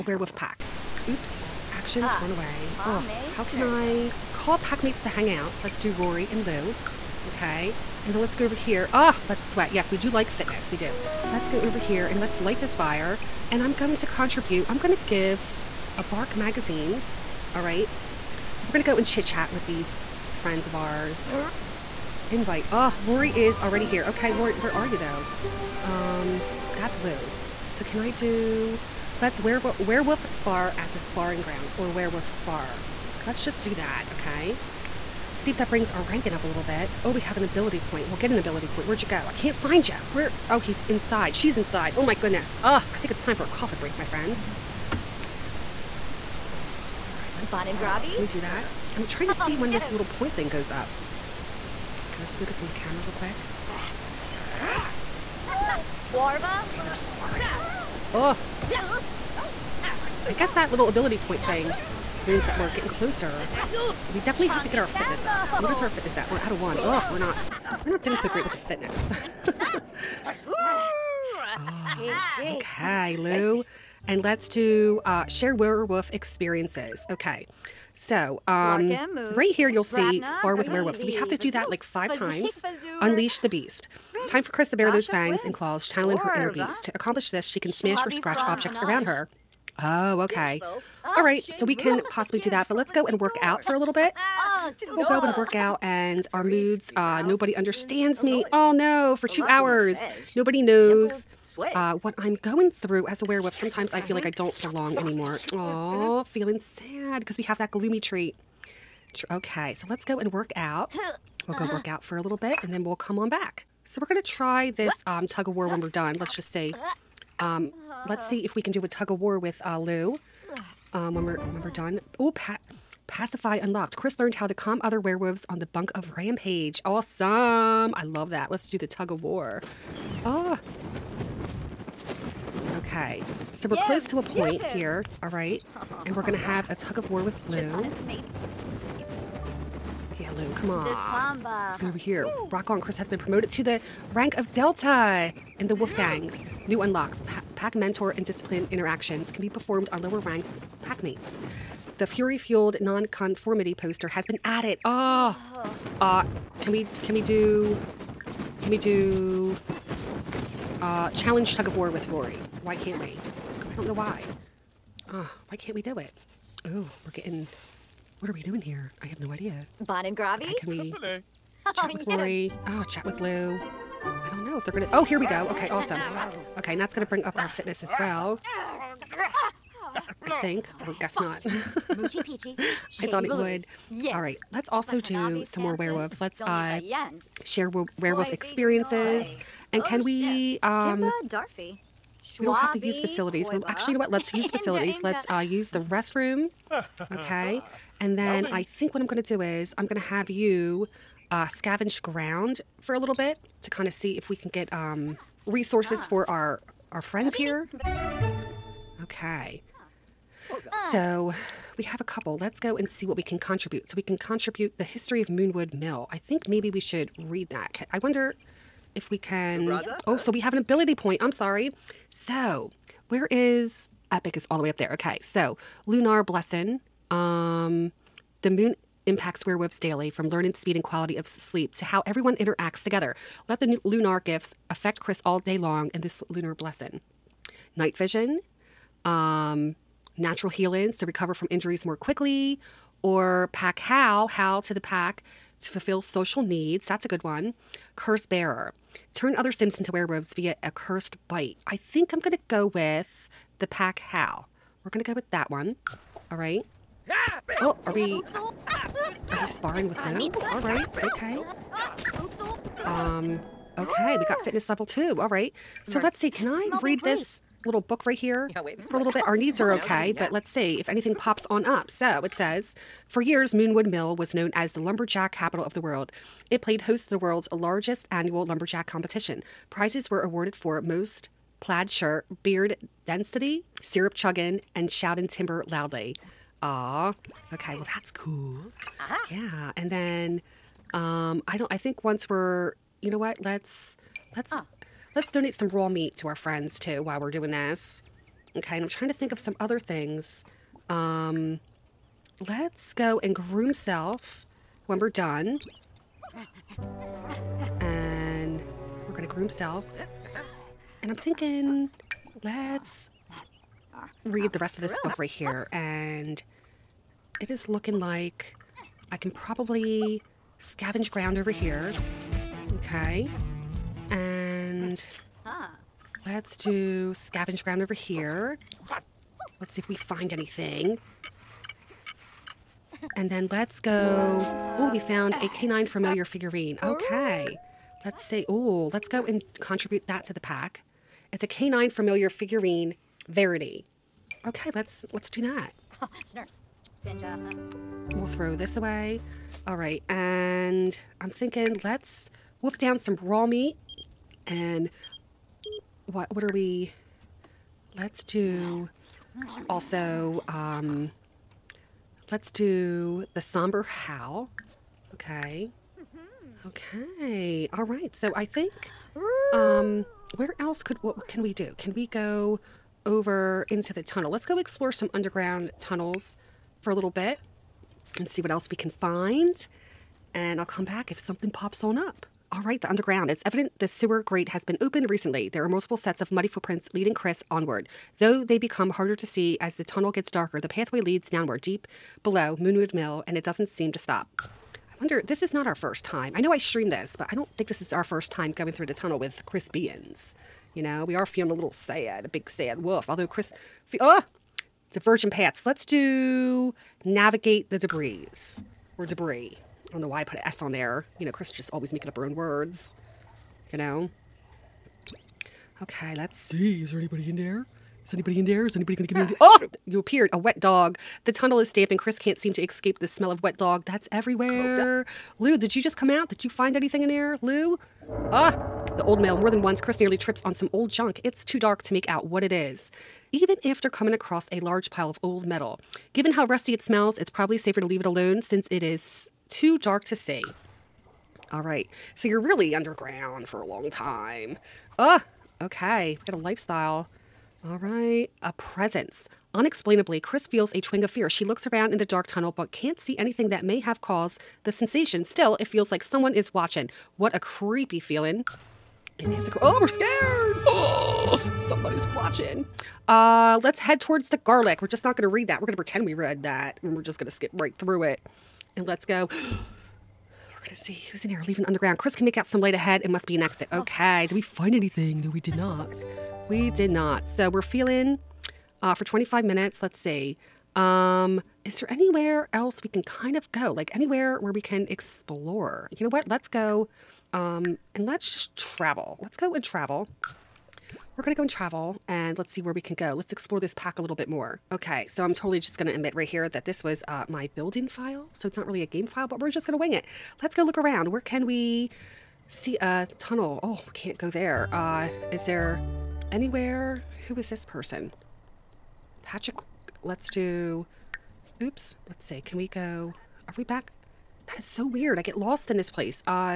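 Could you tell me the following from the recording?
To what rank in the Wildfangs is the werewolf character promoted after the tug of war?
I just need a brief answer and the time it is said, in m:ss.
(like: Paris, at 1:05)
Delta, at 2:24.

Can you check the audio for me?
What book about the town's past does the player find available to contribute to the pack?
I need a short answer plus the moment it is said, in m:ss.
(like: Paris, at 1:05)
The History of Moonwood Mill, at 3:34.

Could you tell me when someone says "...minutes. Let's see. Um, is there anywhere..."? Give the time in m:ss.
7:59.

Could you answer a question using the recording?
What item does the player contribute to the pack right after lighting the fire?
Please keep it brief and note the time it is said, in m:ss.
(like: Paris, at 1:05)
Bark magazine, at 0:16.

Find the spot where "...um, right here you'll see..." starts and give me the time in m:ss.
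1:18.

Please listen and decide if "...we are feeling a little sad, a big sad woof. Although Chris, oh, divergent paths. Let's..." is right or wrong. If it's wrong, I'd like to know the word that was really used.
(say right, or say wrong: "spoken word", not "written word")
right.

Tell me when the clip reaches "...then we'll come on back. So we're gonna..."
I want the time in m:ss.
1:52.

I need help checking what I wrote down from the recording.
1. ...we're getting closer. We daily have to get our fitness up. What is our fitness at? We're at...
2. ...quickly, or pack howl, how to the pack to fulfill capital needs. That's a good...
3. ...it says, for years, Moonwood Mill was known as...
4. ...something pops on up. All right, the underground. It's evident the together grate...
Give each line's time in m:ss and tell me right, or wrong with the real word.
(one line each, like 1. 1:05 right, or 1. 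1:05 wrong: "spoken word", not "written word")
1. 1:02 wrong: "definitely", not "daily"
2. 4:01 wrong: "social", not "capital"
3. 4:32 right
4. 6:21 wrong: "sewer", not "together".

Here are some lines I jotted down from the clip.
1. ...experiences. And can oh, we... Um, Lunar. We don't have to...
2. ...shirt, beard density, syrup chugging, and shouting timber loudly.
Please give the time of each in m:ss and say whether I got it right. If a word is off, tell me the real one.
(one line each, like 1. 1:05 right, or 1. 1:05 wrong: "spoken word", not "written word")
1. 3:08 wrong: "Darfy", not "Lunar"
2. 4:41 right.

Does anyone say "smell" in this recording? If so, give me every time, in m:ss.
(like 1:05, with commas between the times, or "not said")
7:03, 7:16.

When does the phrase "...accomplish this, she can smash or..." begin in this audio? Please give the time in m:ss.
1:26.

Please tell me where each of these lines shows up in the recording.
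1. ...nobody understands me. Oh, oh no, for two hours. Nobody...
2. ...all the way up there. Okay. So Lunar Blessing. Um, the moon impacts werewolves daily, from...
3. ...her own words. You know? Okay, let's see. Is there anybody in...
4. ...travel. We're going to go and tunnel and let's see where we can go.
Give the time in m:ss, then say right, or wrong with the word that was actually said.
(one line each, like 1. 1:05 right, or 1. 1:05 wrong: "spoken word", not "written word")
1. 1:37 right
2. 3:44 right
3. 6:52 right
4. 8:09 wrong: "travel", not "tunnel".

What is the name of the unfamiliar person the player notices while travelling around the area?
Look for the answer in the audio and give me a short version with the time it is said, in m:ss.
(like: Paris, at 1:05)
Patrick, at 8:29.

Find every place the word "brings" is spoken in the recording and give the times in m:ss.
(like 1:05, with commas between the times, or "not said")
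0:35, 2:57.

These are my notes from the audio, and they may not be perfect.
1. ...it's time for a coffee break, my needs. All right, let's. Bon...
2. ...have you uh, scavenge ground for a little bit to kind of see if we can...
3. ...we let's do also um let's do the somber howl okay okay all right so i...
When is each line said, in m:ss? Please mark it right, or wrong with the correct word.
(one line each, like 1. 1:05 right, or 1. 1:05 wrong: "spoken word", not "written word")
1. 0:43 wrong: "friends", not "needs"
2. 3:19 right
3. 5:56 right.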